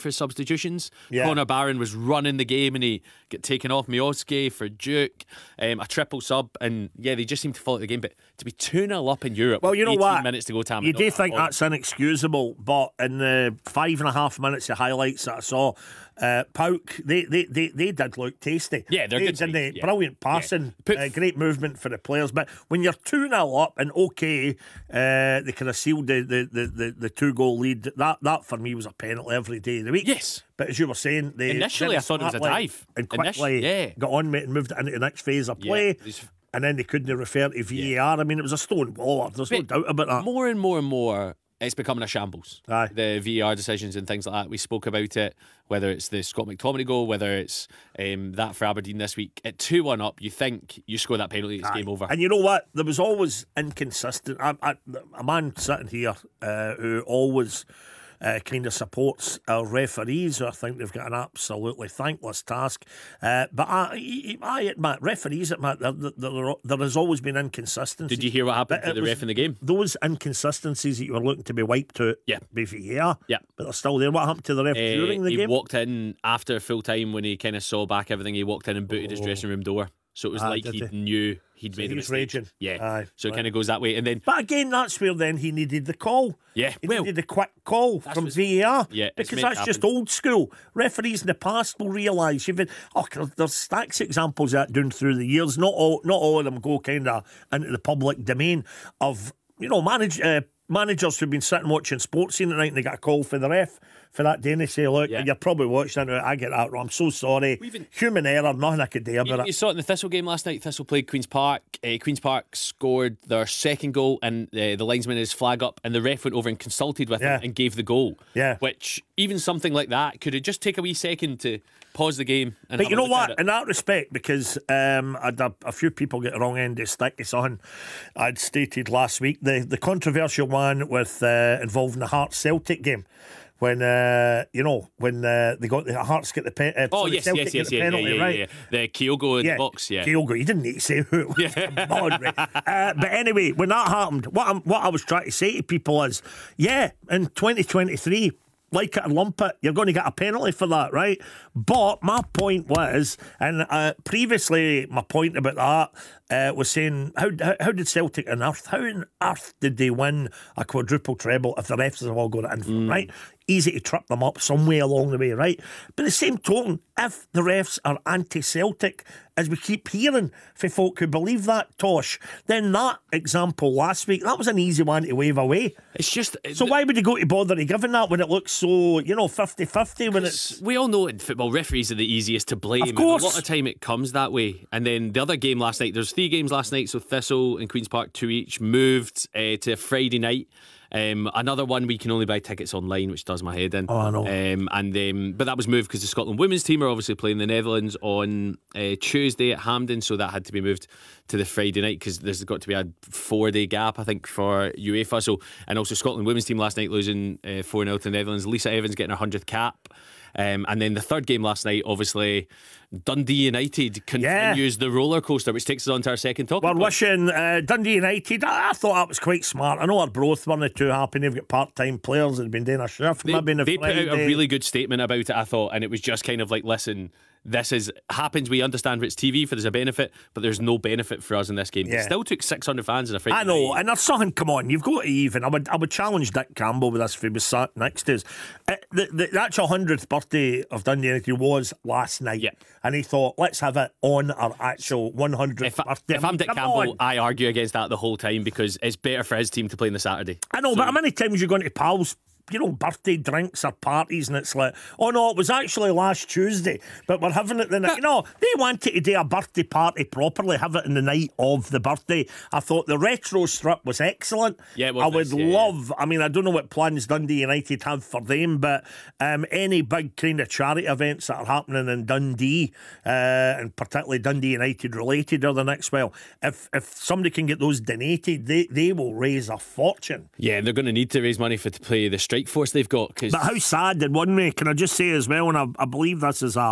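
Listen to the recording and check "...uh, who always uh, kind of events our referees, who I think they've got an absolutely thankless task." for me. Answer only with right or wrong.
wrong.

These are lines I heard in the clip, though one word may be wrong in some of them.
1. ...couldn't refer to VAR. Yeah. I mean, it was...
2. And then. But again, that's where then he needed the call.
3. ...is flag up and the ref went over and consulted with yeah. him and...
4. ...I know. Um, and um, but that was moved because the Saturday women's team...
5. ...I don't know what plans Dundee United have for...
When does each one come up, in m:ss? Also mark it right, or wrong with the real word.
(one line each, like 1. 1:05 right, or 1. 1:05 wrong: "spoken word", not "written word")
1. 0:36 right
2. 1:23 right
3. 1:55 right
4. 3:13 wrong: "Scotland", not "Saturday"
5. 4:26 right.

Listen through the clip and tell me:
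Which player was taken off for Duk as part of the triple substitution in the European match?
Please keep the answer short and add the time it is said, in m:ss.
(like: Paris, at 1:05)
Miovski, at 0:03.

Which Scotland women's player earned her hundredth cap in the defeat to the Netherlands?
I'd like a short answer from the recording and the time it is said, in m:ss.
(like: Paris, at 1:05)
Lisa Evans, at 3:28.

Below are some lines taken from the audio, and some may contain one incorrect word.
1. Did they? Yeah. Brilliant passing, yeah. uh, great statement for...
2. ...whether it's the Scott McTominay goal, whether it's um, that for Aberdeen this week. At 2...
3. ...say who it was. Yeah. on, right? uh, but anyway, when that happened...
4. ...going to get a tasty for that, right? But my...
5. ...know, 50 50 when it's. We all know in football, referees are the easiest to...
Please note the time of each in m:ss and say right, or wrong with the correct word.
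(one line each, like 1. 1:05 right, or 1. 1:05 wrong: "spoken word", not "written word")
1. 0:19 wrong: "movement", not "statement"
2. 0:45 right
3. 2:20 right
4. 2:29 wrong: "penalty", not "tasty"
5. 2:59 right.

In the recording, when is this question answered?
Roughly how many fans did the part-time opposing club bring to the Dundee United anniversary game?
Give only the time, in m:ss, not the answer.
3:52.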